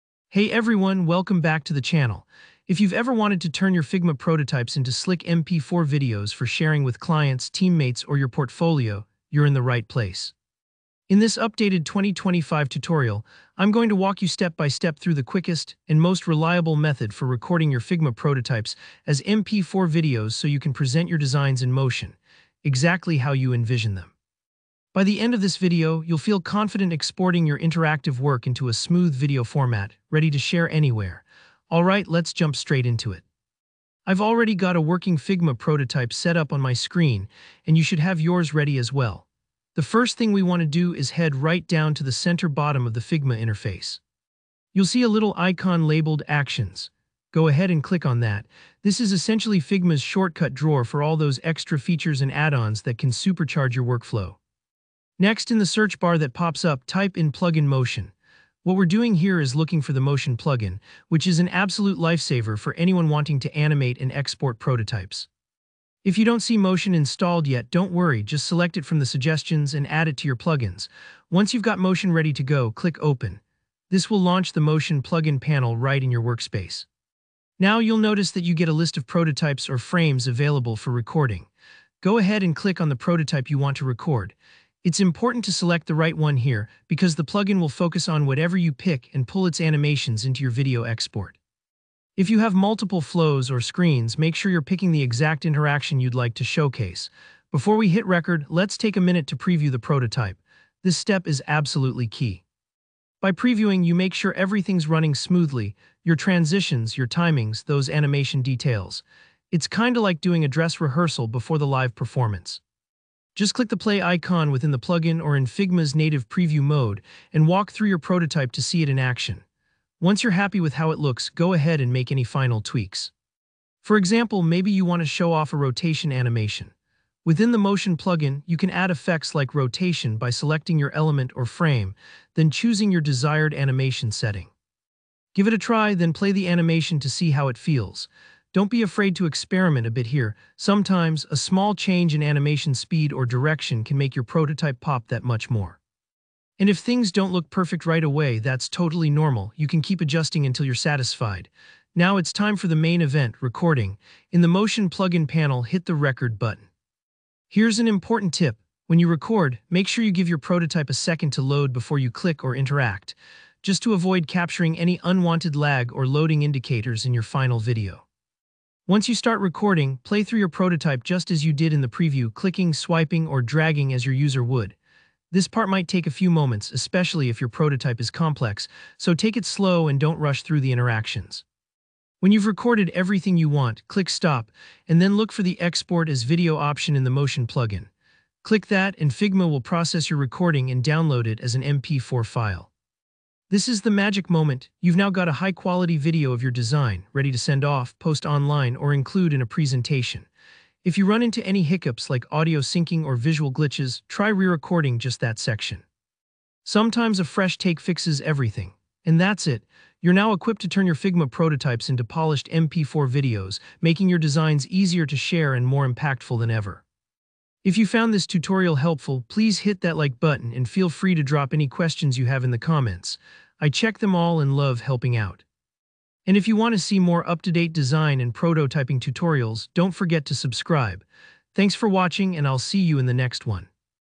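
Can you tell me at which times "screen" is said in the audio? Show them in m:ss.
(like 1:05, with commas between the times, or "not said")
0:36, 1:33.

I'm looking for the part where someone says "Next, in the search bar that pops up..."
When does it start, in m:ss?
0:55.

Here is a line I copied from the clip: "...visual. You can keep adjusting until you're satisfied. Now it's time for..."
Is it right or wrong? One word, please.
wrong.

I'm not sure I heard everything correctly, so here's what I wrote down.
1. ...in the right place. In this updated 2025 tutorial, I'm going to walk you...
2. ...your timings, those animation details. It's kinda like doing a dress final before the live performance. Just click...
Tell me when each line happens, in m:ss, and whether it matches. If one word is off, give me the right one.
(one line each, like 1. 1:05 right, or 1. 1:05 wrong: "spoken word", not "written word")
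1. 0:09 right
2. 1:46 wrong: "rehearsal", not "final".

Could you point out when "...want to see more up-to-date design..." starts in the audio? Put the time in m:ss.
3:46.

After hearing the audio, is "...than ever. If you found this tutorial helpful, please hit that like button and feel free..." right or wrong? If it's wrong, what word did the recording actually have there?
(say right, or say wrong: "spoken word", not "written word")
right.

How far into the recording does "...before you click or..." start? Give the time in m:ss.
2:41.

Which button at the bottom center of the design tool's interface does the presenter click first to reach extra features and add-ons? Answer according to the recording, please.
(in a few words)
Actions.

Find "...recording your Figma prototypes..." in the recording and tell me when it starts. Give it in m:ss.
0:17.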